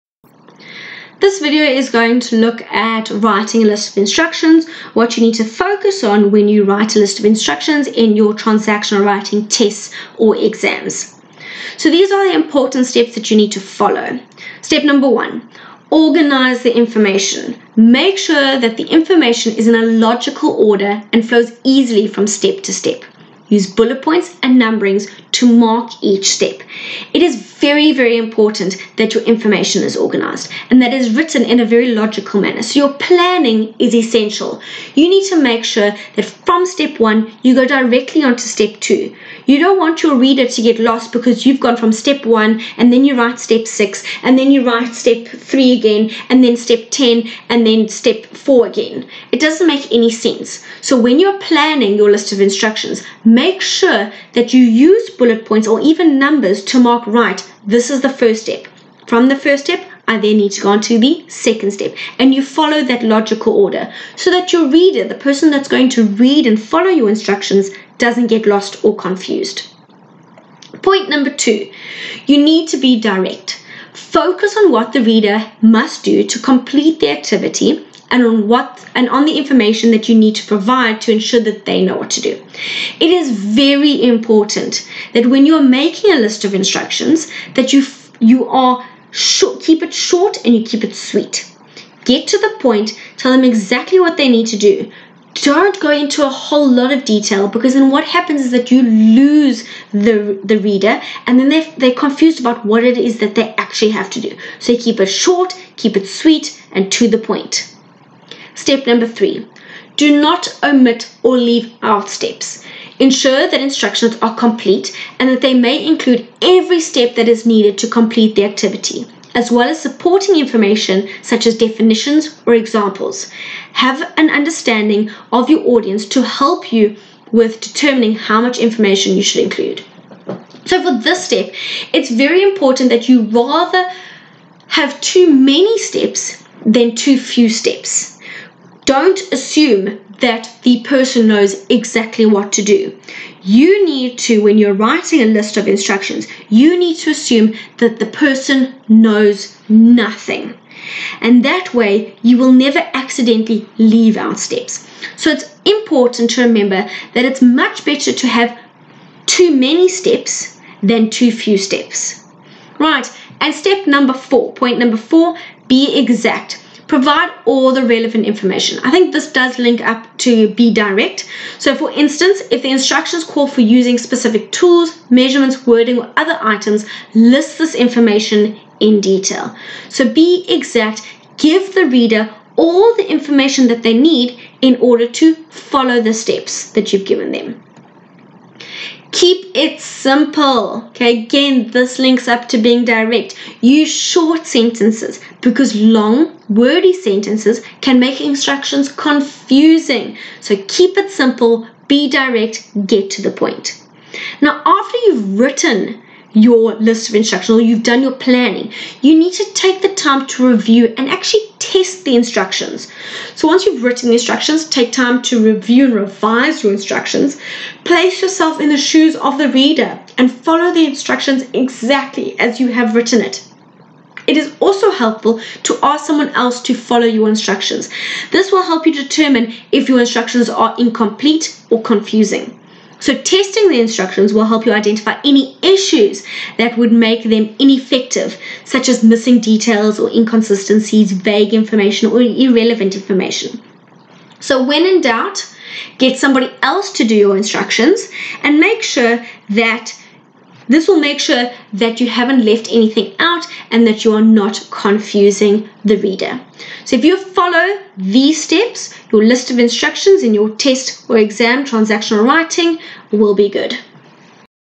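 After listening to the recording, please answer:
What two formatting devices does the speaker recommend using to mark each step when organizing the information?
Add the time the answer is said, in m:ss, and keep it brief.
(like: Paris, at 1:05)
bullet points and numberings, at 0:23.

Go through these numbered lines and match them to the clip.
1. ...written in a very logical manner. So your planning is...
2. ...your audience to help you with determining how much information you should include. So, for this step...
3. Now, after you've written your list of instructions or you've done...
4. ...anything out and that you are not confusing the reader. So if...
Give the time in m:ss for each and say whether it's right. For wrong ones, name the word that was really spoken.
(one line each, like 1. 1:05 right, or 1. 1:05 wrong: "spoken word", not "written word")
1. 0:31 right
2. 2:05 right
3. 3:24 right
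4. 4:12 right.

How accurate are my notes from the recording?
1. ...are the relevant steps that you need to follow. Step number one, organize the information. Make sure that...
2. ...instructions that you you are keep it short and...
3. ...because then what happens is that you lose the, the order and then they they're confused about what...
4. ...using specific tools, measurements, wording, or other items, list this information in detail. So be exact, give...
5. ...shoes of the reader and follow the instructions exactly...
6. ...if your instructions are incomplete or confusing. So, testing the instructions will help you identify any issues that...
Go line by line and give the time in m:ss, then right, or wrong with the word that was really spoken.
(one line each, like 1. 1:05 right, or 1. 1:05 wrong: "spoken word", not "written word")
1. 0:12 wrong: "important", not "relevant"
2. 1:26 right
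3. 1:37 wrong: "reader", not "order"
4. 2:53 right
5. 3:38 right
6. 3:49 right.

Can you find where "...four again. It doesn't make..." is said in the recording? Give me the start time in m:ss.
0:48.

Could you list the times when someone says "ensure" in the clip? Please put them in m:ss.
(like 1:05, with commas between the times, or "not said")
1:21, 1:52.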